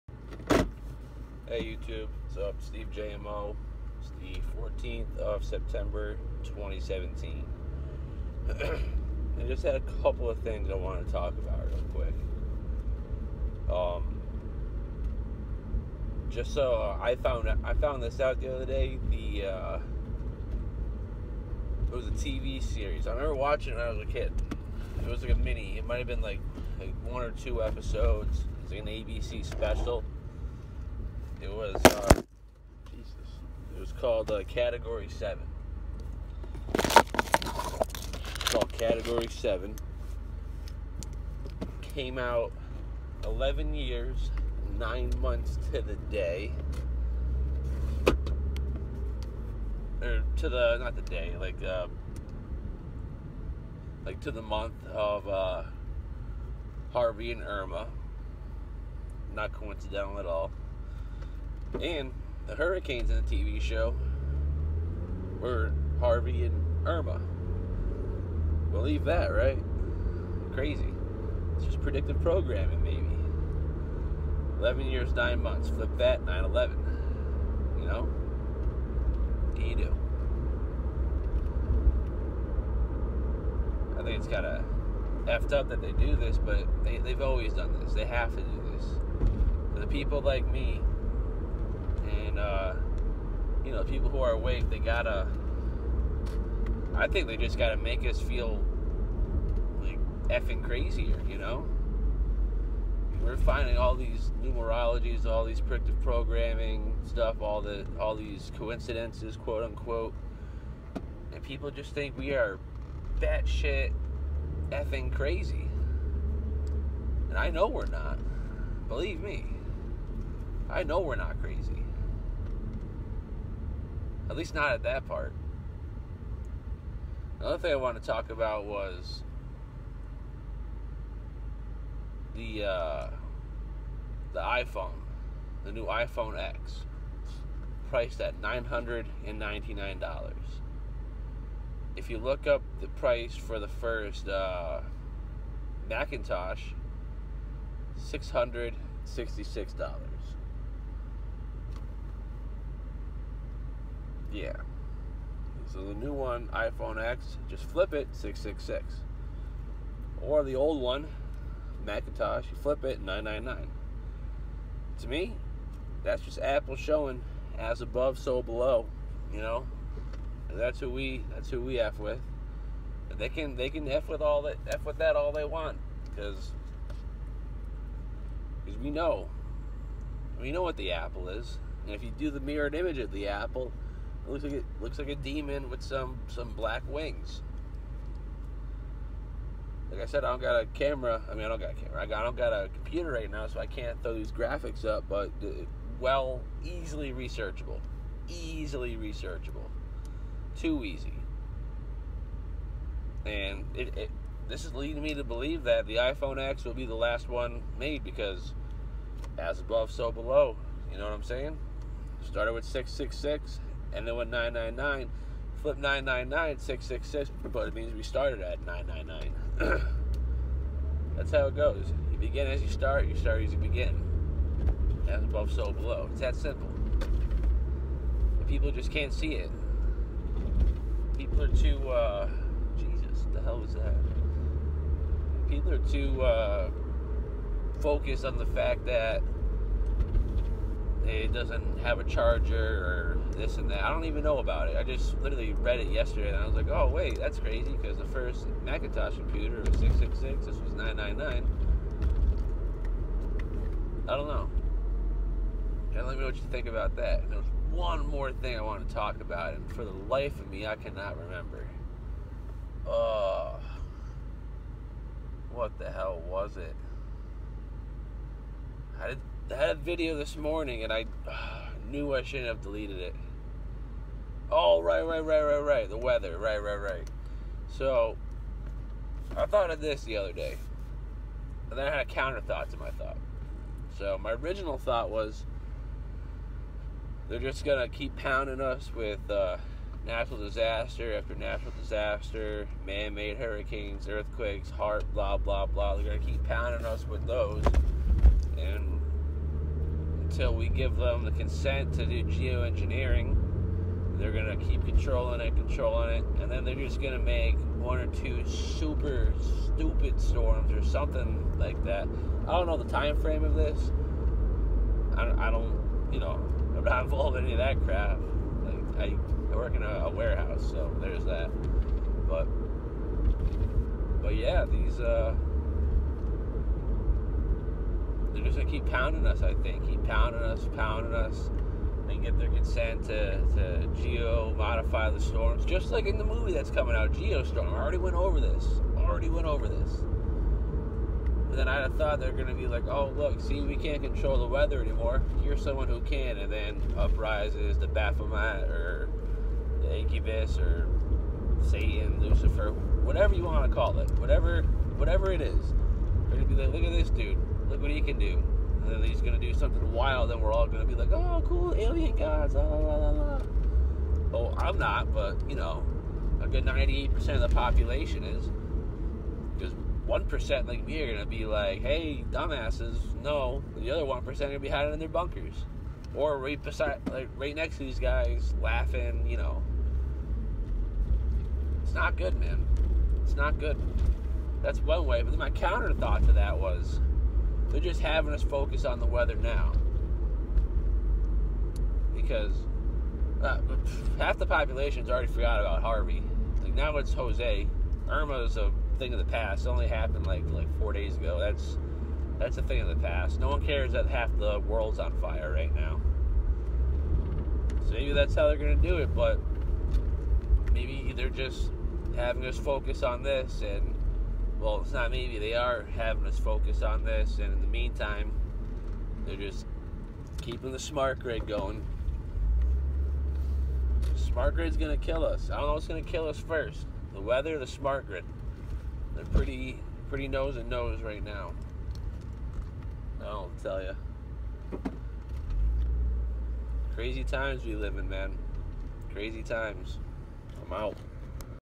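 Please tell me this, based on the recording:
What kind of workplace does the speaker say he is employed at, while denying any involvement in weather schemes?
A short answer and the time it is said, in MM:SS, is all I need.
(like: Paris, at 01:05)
a warehouse, at 05:20.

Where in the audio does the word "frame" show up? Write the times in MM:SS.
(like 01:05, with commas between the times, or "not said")
05:13.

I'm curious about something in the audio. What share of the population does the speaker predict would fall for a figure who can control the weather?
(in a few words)
98%.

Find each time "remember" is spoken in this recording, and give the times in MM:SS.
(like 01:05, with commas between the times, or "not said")
00:23, 04:21.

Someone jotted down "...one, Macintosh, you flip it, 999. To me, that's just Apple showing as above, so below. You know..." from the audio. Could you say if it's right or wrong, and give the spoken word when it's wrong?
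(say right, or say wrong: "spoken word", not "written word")
right.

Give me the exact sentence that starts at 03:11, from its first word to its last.
I mean, I don't got a camera.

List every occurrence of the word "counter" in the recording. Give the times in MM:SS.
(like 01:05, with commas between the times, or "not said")
04:42, 06:25.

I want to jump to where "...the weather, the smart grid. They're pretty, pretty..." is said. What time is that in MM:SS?
07:07.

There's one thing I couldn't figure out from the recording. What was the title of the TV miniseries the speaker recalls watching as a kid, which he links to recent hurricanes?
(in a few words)
Category 7.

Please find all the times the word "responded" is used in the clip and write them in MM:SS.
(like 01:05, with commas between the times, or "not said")
not said.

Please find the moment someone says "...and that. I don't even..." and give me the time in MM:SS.
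04:03.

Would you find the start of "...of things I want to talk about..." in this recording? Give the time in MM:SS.
00:10.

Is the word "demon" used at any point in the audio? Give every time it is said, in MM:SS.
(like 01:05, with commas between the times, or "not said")
03:05.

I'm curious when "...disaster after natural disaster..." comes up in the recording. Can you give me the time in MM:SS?
04:50.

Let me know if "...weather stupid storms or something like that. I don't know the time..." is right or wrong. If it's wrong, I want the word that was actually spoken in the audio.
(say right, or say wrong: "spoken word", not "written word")
wrong: "super", not "weather".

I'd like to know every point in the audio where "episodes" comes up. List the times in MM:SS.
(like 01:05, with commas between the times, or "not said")
00:27.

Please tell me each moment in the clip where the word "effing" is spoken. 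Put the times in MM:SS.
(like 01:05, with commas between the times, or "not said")
01:40, 01:54.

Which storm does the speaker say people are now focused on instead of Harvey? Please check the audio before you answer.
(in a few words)
Jose.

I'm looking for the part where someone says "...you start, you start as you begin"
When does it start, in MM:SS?
03:42.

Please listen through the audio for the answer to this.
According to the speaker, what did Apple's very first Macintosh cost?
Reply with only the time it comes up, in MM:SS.
02:27.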